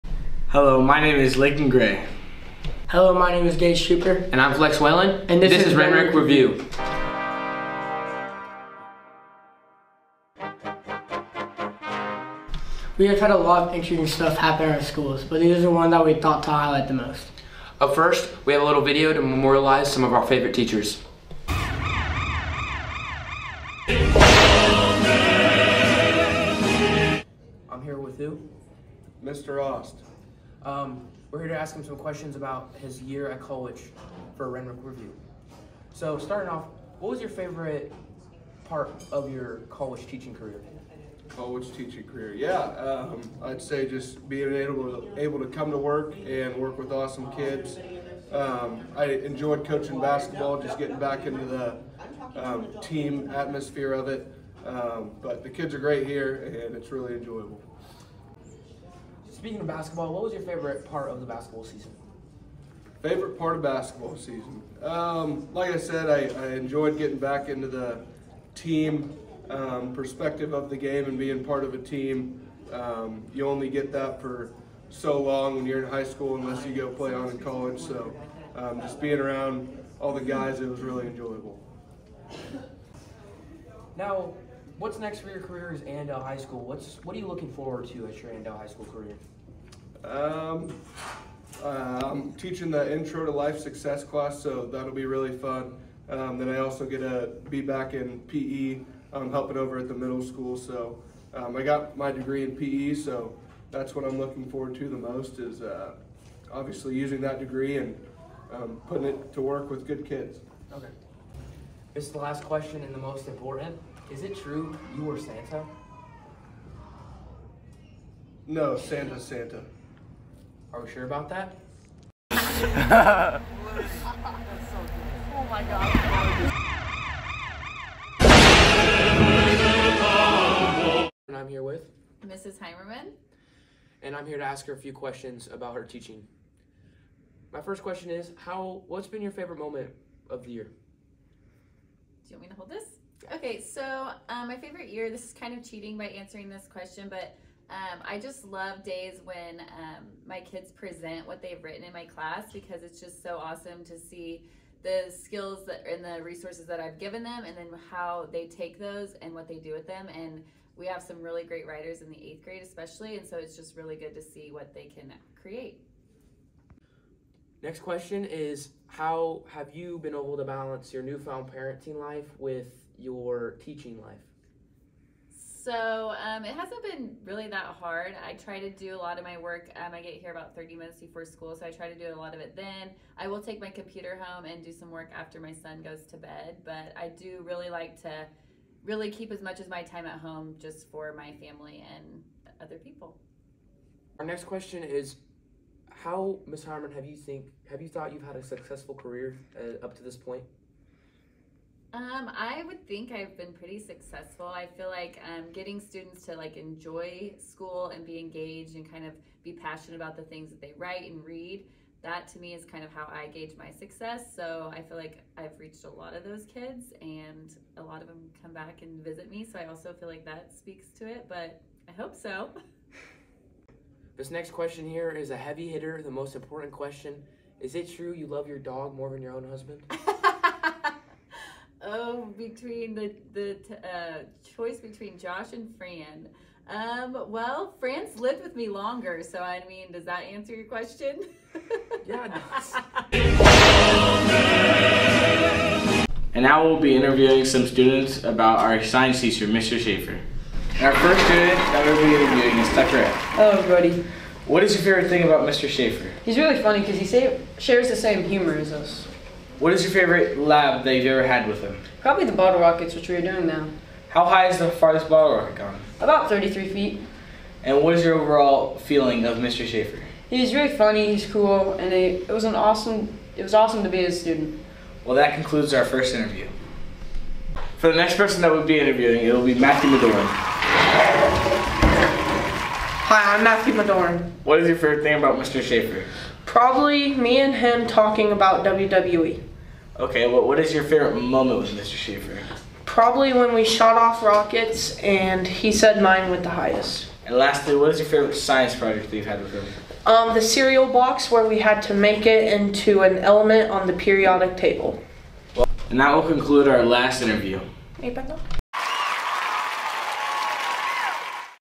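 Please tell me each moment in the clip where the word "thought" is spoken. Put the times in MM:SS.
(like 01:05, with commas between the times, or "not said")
00:16, 03:17.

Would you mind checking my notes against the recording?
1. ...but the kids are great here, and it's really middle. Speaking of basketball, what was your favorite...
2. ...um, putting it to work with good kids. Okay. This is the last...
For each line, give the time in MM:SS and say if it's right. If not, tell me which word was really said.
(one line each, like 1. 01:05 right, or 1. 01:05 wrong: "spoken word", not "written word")
1. 00:55 wrong: "enjoyable", not "middle"
2. 01:48 right.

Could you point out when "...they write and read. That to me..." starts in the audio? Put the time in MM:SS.
03:30.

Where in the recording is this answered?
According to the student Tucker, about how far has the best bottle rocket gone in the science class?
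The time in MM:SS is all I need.
04:26.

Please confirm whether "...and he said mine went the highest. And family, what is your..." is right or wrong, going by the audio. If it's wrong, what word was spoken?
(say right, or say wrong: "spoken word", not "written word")
wrong: "lastly", not "family".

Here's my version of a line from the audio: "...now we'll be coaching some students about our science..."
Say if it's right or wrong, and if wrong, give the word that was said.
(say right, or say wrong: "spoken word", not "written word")
wrong: "interviewing", not "coaching".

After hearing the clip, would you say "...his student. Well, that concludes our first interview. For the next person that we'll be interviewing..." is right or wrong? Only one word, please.
right.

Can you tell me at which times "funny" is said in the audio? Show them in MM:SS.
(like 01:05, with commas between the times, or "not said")
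04:16, 04:30.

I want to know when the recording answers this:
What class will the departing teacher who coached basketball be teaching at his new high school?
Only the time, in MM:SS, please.
01:32.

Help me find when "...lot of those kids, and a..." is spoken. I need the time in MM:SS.
03:35.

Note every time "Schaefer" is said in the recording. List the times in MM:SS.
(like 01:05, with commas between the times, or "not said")
04:09, 04:15, 04:29, 04:45, 04:51.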